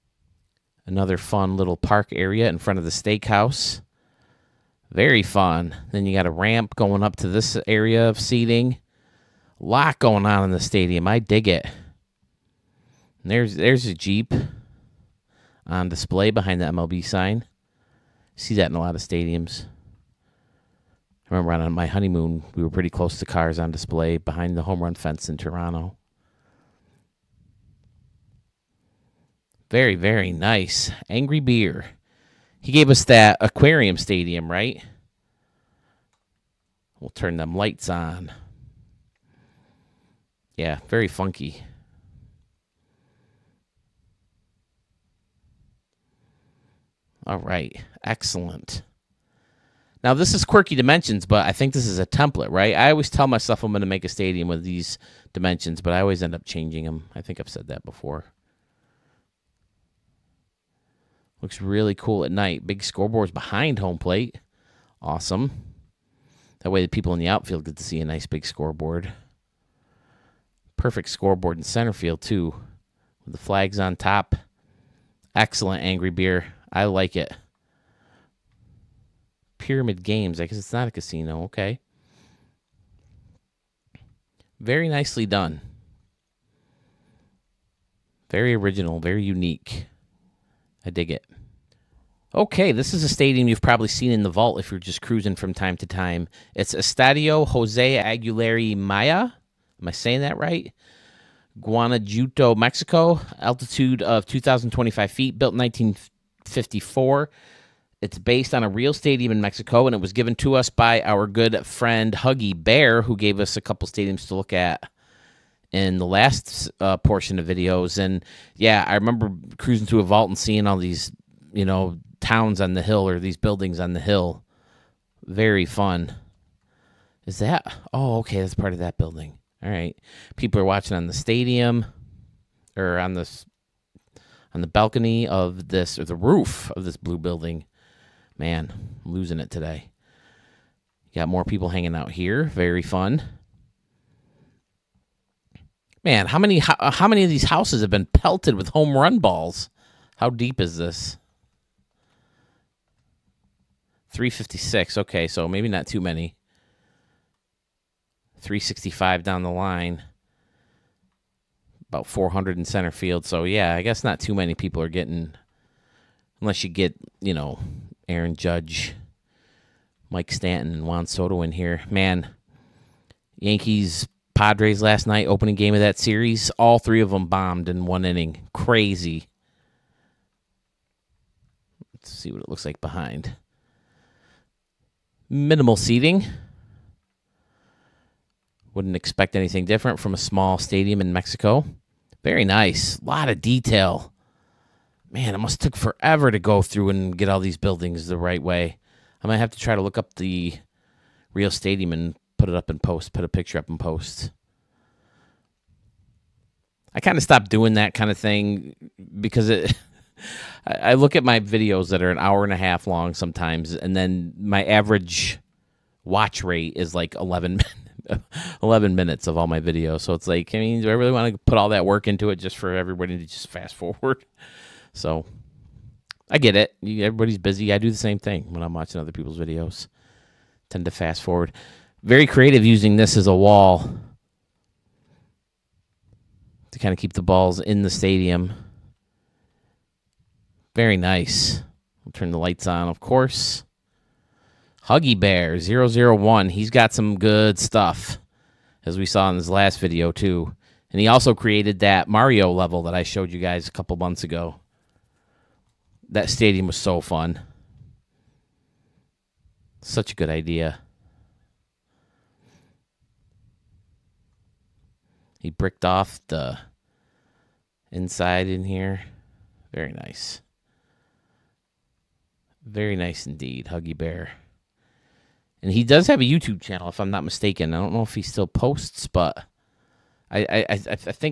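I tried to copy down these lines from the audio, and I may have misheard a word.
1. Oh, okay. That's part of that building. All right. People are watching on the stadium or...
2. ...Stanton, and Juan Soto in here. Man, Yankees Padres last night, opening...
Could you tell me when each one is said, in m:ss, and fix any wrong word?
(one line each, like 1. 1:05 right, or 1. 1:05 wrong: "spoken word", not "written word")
1. 2:07 right
2. 2:50 right.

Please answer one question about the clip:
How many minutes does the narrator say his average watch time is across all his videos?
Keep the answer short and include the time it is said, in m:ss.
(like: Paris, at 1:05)
11 minutes, at 3:38.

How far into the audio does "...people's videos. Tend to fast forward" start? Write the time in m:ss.
3:49.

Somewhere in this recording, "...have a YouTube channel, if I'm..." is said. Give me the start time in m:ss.
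4:36.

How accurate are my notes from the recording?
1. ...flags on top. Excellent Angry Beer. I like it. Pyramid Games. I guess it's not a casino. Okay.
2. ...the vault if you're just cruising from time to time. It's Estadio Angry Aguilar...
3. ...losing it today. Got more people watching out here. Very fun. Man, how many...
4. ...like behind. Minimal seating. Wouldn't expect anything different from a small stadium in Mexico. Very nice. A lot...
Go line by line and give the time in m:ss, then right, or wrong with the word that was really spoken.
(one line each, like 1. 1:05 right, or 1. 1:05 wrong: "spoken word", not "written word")
1. 1:13 right
2. 1:34 wrong: "Jose", not "Angry"
3. 2:19 wrong: "hanging", not "watching"
4. 3:02 right.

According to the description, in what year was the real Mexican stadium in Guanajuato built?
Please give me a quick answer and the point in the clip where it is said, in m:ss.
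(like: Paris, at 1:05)
1954, at 1:45.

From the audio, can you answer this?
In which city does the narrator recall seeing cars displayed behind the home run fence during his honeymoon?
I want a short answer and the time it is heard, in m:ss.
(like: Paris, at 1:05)
Toronto, at 0:25.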